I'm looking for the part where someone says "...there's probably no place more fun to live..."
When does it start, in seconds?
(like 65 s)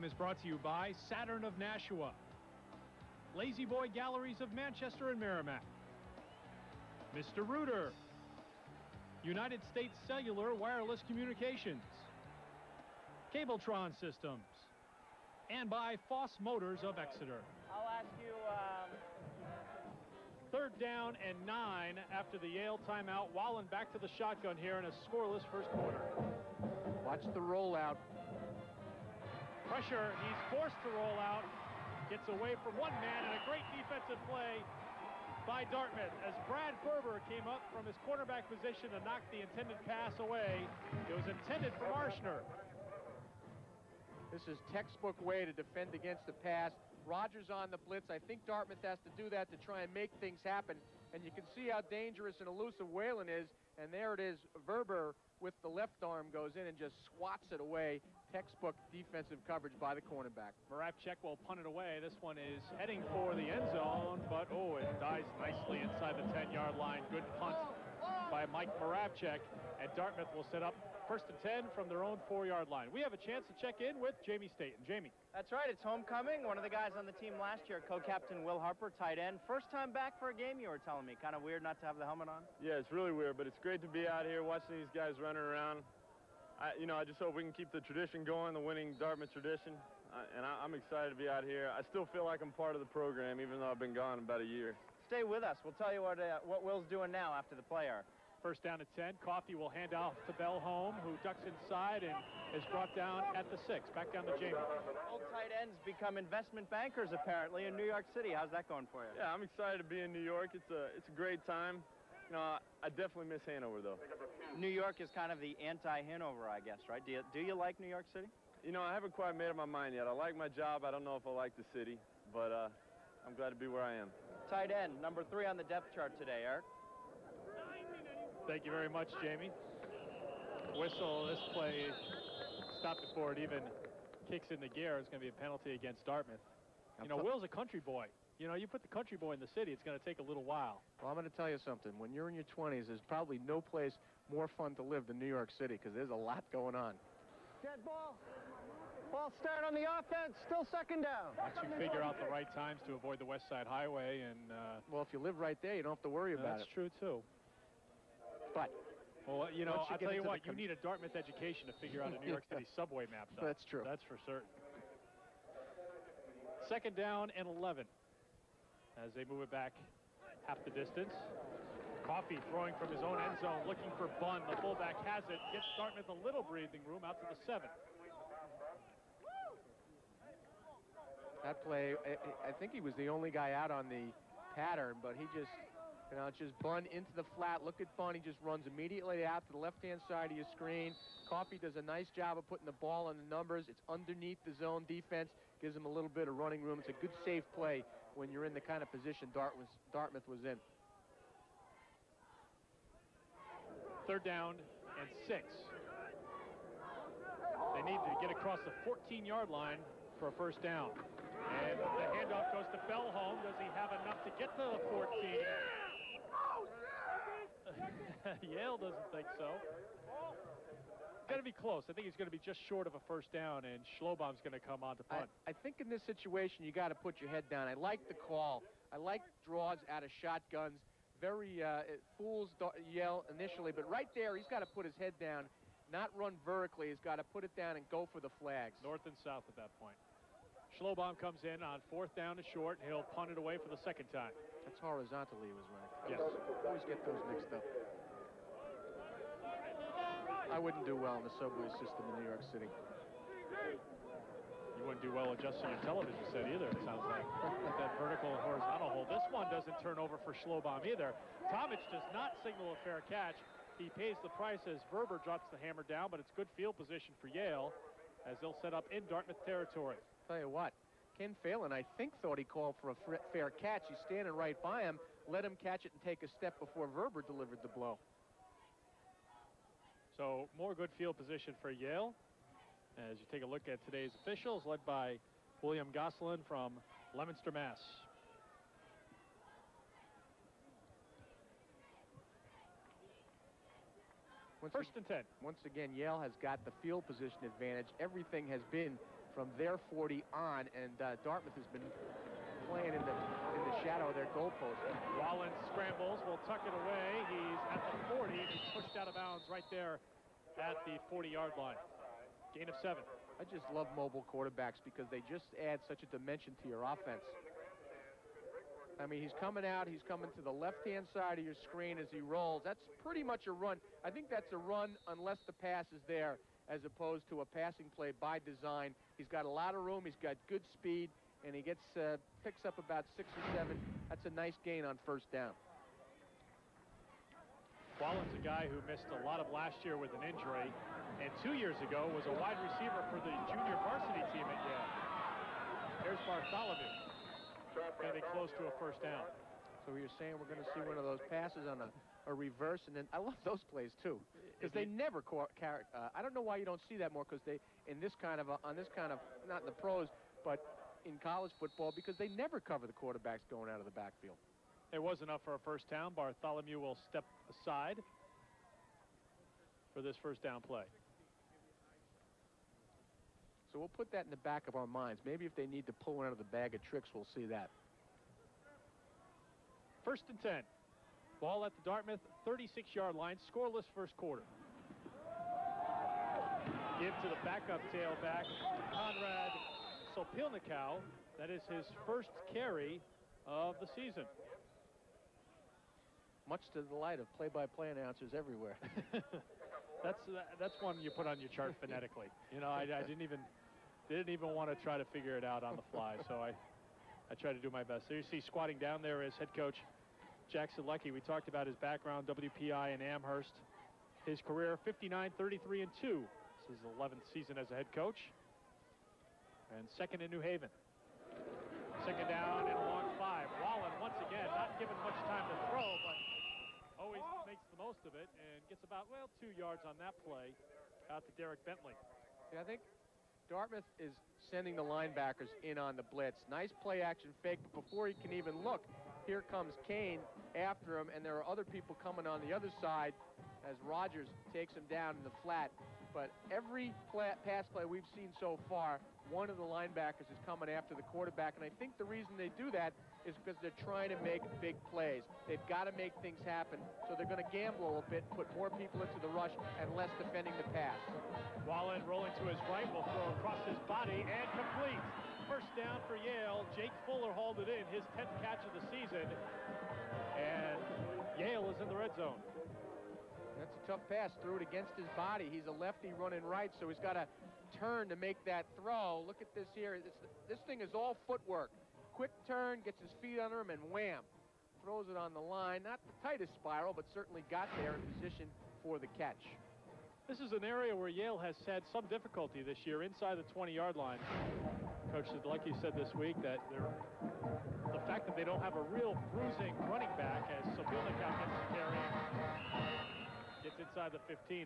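142 s.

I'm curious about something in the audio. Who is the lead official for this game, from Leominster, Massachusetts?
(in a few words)
William Gosselin.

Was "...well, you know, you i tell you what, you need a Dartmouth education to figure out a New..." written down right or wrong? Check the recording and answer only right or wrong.
right.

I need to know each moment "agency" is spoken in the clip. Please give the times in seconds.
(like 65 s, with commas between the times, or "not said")
not said.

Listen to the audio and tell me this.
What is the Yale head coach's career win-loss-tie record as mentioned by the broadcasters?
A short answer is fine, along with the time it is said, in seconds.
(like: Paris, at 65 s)
59-33-2, at 414 s.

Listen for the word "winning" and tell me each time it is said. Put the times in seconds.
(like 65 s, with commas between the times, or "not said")
88 s.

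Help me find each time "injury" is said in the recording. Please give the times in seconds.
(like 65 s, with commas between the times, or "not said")
340 s.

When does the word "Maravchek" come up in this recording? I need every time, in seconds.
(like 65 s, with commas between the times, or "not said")
60 s, 68 s.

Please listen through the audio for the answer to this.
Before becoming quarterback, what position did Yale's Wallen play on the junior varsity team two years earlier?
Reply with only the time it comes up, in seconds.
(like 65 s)
342 s.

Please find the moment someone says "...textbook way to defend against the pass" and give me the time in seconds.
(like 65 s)
44 s.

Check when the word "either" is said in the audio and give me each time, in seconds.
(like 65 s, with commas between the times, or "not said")
256 s, 260 s.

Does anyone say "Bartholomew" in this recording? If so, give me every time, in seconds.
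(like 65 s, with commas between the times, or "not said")
346 s, 366 s.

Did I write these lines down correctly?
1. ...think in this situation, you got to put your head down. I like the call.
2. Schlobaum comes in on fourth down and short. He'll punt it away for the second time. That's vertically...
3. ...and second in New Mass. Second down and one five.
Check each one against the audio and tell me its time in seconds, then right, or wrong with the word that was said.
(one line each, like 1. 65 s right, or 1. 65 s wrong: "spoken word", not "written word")
1. 225 s right
2. 240 s wrong: "horizontally", not "vertically"
3. 419 s wrong: "Haven", not "Mass".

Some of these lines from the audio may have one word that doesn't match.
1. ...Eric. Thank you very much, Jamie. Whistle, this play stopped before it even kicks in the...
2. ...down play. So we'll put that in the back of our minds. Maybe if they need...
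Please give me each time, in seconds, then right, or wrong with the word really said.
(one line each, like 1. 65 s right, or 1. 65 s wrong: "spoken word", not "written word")
1. 126 s right
2. 370 s right.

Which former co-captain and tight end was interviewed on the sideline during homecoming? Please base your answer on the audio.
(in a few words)
Will Harper.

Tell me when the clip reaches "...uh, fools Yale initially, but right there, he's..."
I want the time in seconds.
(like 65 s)
231 s.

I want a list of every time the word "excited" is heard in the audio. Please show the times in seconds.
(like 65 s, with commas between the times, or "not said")
90 s, 109 s.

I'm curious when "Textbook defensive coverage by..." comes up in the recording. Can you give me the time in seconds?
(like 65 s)
58 s.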